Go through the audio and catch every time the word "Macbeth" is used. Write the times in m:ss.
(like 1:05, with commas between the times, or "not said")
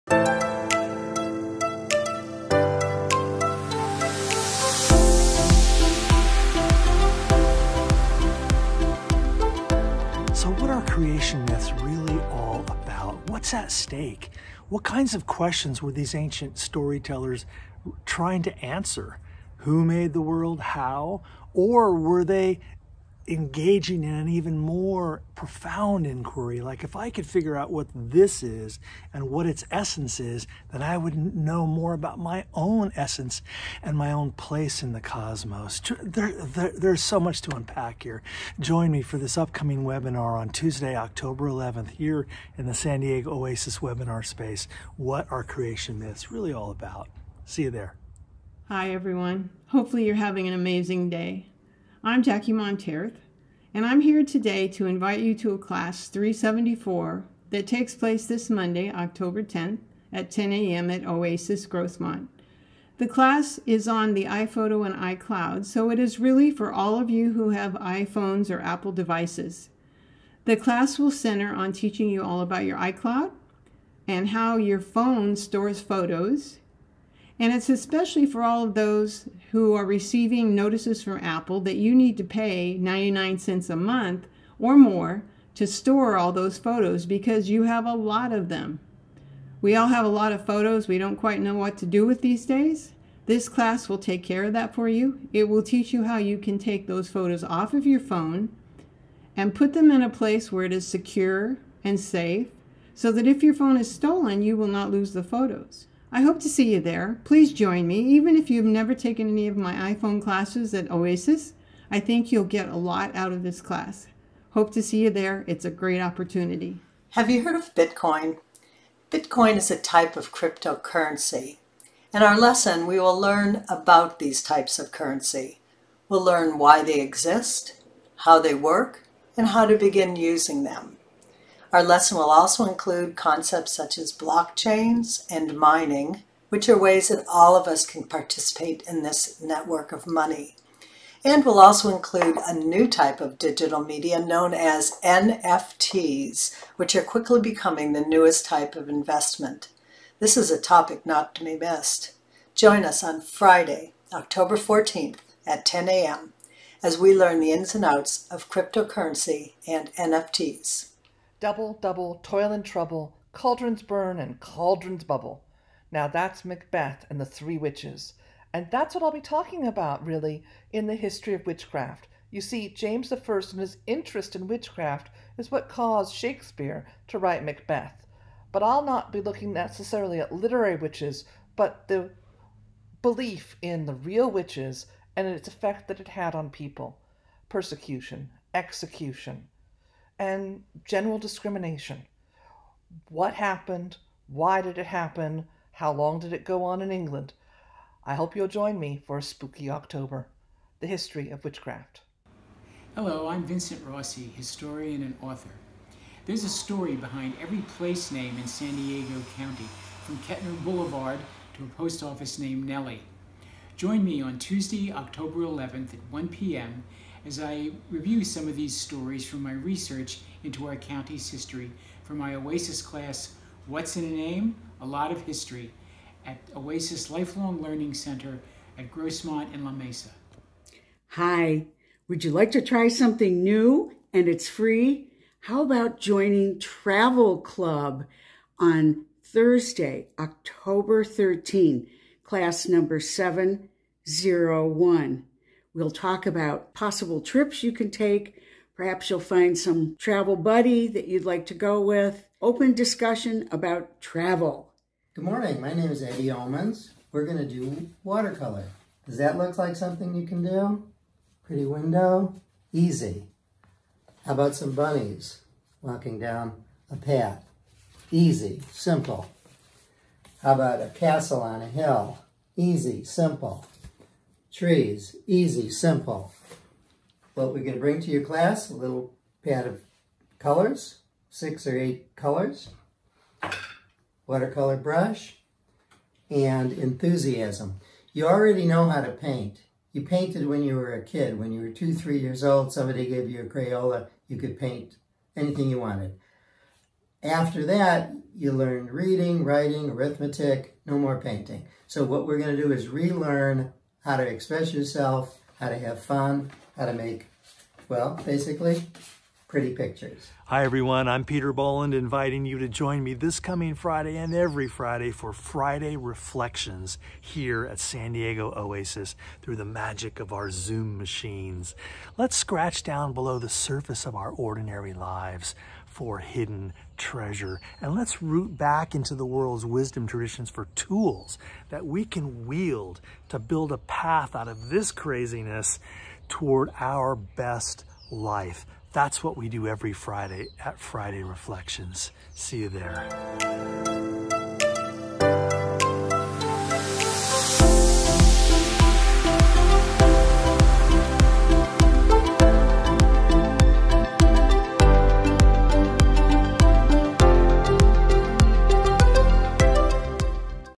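2:46, 2:57.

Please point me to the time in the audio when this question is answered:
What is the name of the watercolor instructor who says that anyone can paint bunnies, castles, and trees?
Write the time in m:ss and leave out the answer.
4:16.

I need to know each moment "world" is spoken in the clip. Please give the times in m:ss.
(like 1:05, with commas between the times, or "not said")
0:20, 5:29.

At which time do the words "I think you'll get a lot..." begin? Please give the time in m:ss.
1:51.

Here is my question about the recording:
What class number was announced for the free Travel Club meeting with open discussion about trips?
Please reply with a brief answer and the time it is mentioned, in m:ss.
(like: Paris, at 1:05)
701, at 4:02.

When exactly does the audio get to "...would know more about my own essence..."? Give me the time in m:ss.
0:30.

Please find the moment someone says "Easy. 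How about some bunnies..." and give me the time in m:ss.
4:22.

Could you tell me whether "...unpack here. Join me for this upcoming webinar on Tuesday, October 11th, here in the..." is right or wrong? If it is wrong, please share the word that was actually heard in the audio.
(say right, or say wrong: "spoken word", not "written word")
right.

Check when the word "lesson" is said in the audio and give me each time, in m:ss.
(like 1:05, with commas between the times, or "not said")
2:02, 2:11.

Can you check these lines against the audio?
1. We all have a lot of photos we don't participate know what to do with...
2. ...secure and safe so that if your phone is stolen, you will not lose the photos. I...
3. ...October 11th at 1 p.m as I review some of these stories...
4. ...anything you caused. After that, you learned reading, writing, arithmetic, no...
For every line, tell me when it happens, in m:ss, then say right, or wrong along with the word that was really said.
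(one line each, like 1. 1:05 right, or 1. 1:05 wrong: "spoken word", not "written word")
1. 1:29 wrong: "quite", not "participate"
2. 1:40 right
3. 3:34 right
4. 4:55 wrong: "wanted", not "caused".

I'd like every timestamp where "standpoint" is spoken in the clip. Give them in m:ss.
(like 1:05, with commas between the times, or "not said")
not said.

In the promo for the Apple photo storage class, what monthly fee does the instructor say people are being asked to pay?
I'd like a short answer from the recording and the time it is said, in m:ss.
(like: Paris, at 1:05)
99 cents, at 1:22.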